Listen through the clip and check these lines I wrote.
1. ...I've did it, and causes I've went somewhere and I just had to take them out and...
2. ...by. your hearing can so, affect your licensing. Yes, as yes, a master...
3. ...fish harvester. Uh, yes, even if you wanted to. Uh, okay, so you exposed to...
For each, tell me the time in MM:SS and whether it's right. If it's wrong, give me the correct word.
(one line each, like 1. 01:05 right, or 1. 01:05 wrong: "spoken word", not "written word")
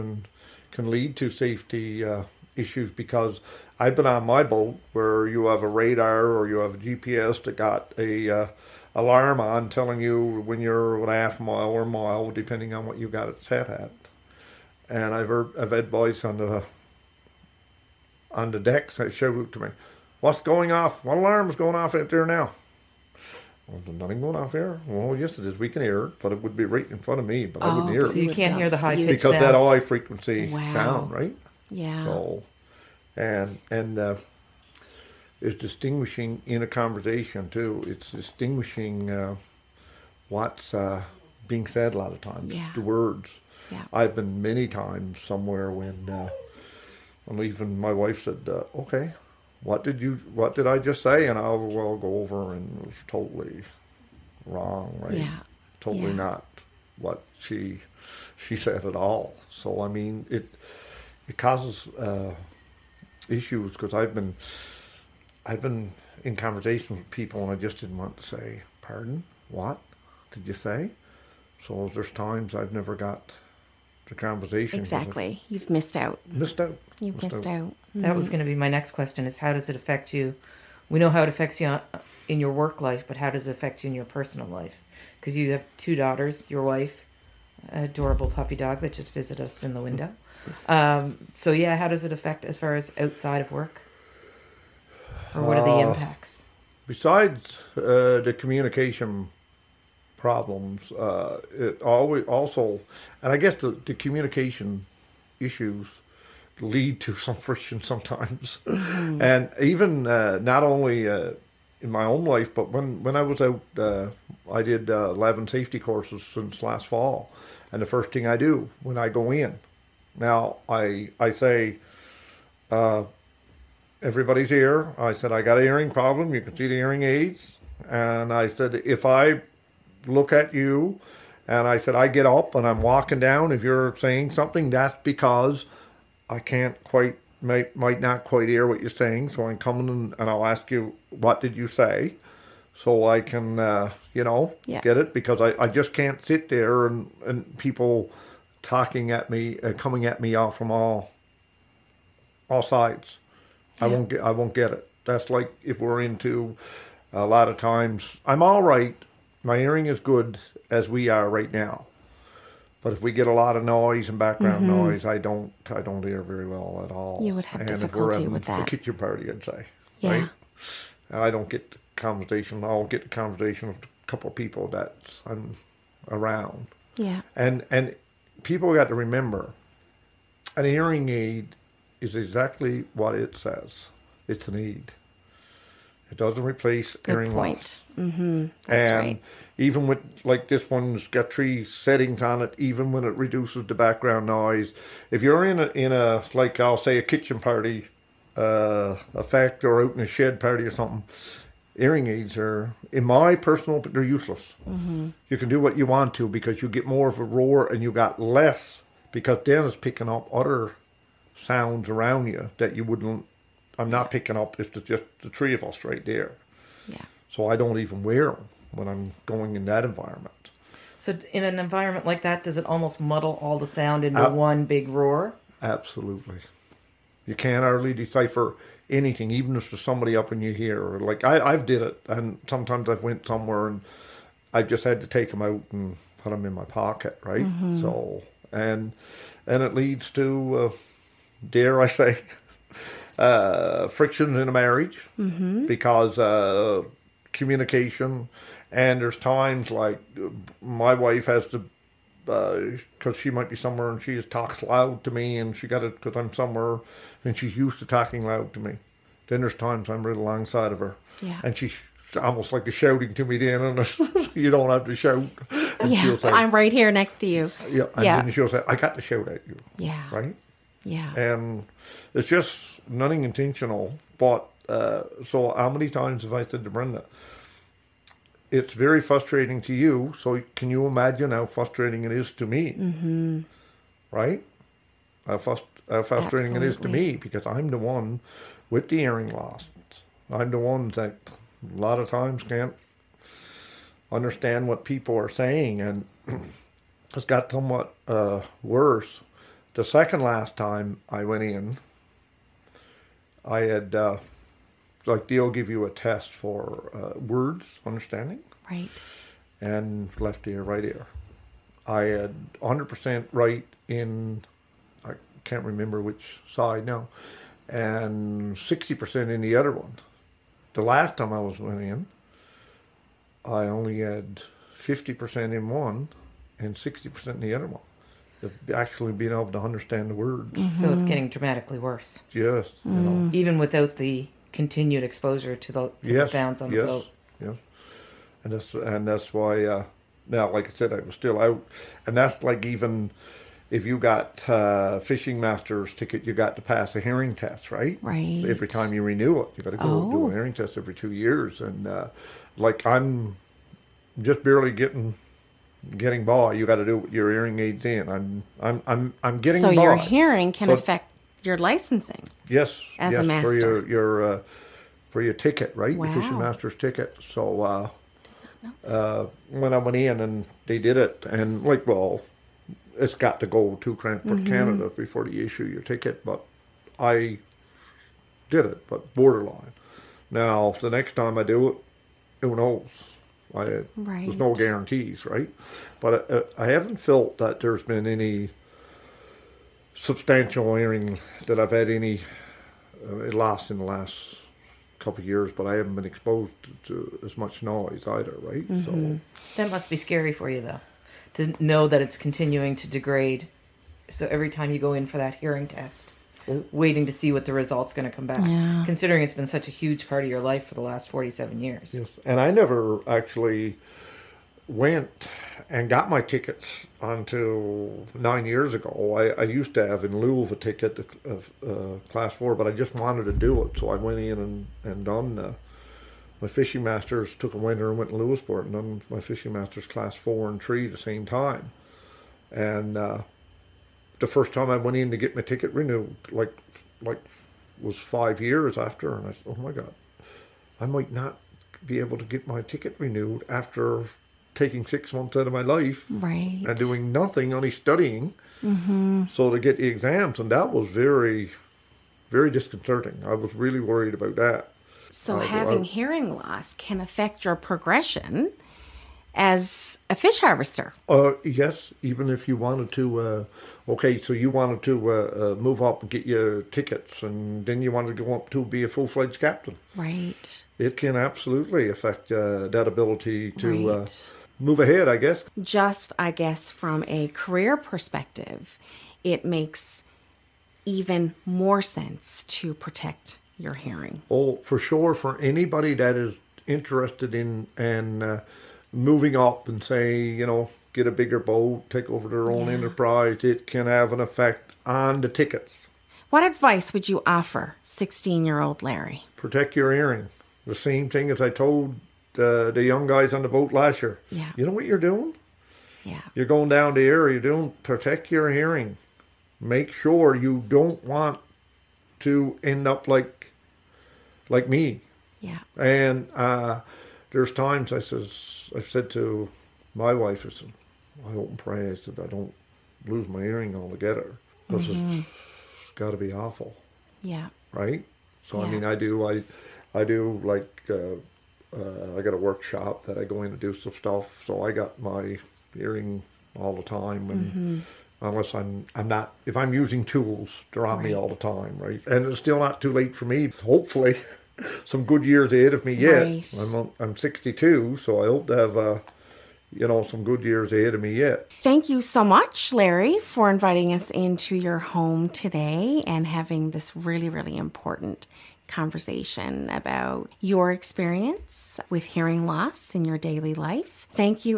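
1. 03:51 wrong: "sometimes", not "causes"
2. 05:59 right
3. 07:40 wrong: "wanted", not "exposed".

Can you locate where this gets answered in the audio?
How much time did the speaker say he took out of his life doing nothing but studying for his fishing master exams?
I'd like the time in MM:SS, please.
07:24.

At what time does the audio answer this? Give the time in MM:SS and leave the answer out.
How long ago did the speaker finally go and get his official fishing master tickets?
06:58.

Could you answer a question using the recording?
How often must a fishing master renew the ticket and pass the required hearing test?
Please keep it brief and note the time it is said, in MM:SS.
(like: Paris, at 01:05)
every 2 years, at 05:50.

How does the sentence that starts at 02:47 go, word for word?
You would have and difficulty with that.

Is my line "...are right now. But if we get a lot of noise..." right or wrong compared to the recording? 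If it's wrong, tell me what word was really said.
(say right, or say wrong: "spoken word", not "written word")
right.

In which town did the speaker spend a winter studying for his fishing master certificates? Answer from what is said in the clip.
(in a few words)
Lewisporte.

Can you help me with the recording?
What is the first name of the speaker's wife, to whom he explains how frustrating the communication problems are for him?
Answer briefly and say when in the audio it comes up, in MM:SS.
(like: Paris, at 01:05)
Brenda, at 04:36.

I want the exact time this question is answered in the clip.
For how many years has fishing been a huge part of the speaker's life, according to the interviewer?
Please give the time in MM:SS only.
06:51.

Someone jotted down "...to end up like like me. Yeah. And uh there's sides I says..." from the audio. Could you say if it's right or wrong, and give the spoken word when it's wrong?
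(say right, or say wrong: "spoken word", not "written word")
wrong: "times", not "sides".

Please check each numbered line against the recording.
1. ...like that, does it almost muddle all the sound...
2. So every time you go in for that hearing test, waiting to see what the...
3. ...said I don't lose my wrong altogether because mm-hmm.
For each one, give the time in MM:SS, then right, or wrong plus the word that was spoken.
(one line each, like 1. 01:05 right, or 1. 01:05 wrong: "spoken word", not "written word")
1. 03:42 right
2. 06:44 right
3. 08:41 wrong: "hearing", not "wrong".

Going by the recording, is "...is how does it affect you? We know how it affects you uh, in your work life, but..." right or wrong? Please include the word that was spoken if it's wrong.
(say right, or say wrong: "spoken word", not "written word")
right.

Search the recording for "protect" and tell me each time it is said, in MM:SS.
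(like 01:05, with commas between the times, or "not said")
08:02, 08:19, 08:27.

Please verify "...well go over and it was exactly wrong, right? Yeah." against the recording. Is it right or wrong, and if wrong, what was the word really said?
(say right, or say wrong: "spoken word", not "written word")
wrong: "totally", not "exactly".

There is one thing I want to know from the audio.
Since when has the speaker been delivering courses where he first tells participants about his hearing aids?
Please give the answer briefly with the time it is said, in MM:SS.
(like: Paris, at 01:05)
last fall, at 01:56.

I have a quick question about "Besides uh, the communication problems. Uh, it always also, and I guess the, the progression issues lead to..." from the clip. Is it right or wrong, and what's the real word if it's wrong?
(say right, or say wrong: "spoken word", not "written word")
wrong: "communication", not "progression".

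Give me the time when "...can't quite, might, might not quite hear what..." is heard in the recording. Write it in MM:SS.
02:16.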